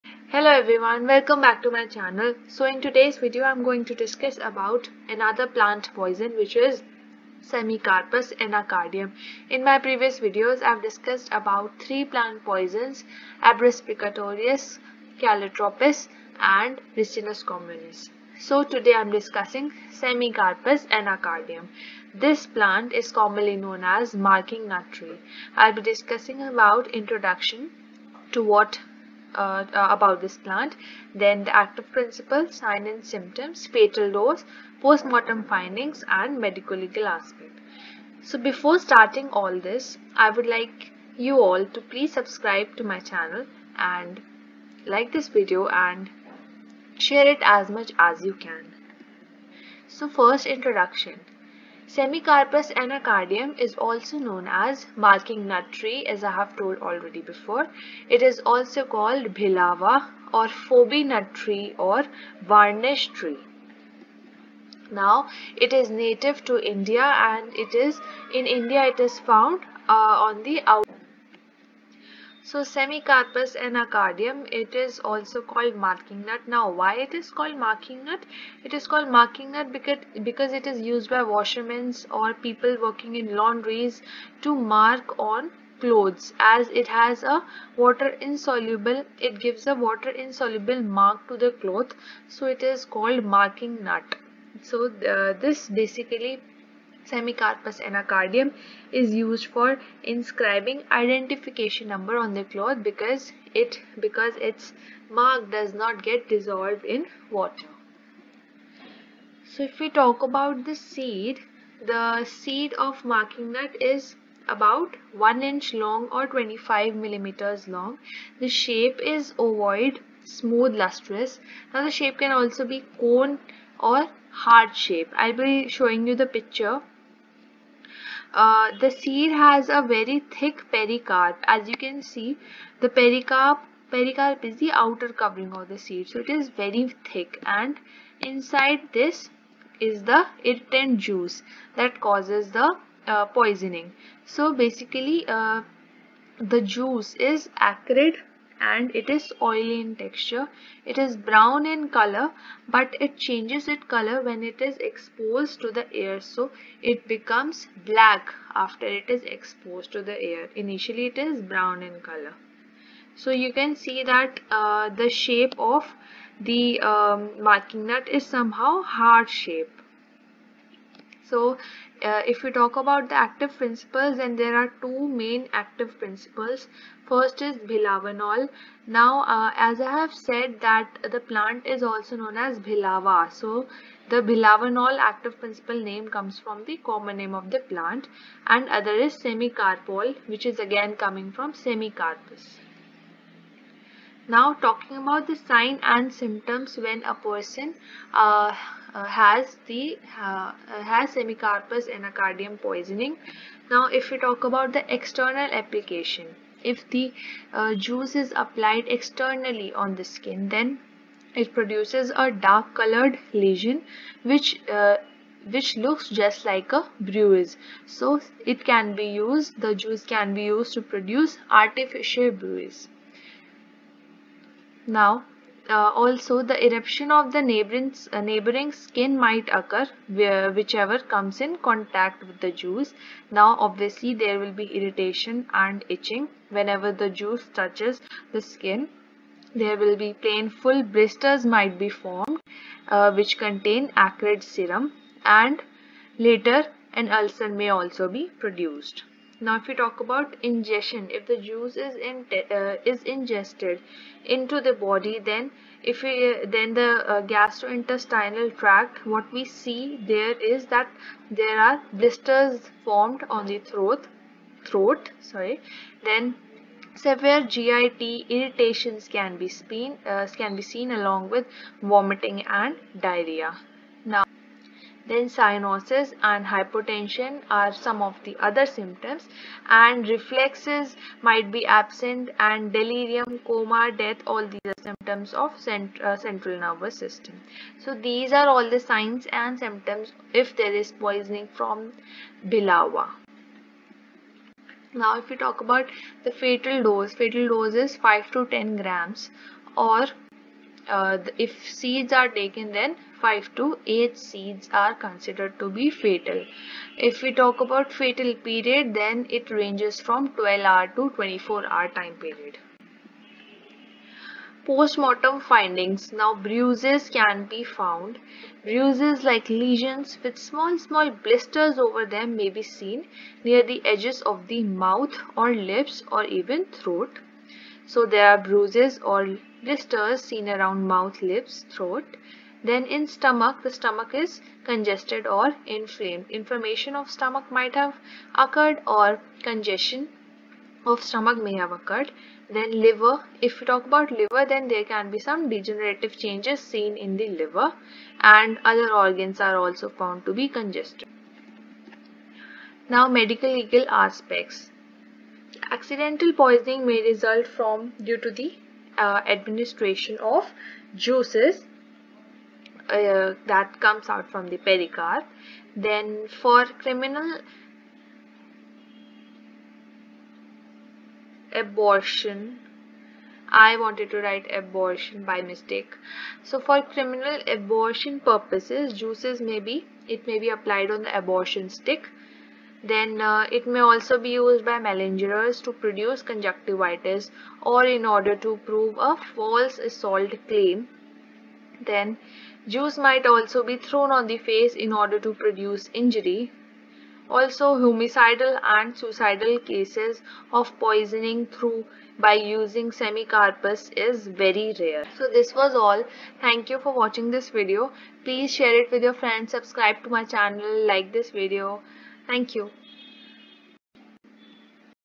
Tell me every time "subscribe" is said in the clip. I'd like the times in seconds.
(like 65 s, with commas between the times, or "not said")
42 s, 409 s.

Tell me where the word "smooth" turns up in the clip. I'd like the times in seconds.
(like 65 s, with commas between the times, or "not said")
120 s.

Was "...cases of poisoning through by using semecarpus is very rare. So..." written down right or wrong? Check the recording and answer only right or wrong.
right.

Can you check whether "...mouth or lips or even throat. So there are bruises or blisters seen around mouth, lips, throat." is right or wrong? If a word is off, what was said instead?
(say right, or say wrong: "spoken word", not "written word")
right.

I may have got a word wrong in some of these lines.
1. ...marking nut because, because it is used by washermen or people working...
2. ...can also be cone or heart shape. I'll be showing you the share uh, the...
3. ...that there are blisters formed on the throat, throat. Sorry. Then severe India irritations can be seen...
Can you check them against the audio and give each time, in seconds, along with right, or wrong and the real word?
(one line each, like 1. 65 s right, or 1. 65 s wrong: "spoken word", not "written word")
1. 79 s right
2. 122 s wrong: "picture", not "share"
3. 260 s wrong: "GIT", not "India".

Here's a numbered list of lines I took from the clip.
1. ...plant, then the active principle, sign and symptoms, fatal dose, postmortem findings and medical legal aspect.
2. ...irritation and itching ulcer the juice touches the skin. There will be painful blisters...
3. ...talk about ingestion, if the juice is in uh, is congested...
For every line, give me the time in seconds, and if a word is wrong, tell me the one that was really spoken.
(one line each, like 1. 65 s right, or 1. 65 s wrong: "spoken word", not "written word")
1. 30 s right
2. 234 s wrong: "whenever", not "ulcer"
3. 249 s wrong: "ingested", not "congested".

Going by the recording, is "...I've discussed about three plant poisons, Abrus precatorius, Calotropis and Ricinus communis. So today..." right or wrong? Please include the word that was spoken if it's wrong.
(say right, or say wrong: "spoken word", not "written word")
right.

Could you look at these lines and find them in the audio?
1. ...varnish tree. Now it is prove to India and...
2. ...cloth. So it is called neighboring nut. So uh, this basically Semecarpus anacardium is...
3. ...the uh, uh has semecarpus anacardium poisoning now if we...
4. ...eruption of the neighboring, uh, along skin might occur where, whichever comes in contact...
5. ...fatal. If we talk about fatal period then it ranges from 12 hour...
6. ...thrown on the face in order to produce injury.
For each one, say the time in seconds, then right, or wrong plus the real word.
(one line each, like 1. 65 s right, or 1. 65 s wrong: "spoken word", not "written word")
1. 62 s wrong: "native", not "prove"
2. 91 s wrong: "marking", not "neighboring"
3. 199 s right
4. 226 s wrong: "neighboring", not "along"
5. 305 s right
6. 393 s right.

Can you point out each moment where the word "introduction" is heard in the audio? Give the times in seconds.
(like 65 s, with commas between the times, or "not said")
26 s, 50 s.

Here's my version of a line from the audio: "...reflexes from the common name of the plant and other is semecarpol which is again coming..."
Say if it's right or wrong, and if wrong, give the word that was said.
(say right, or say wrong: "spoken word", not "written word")
wrong: "comes", not "reflexes".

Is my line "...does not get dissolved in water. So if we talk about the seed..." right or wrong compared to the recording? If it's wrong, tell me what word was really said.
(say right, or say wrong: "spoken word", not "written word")
right.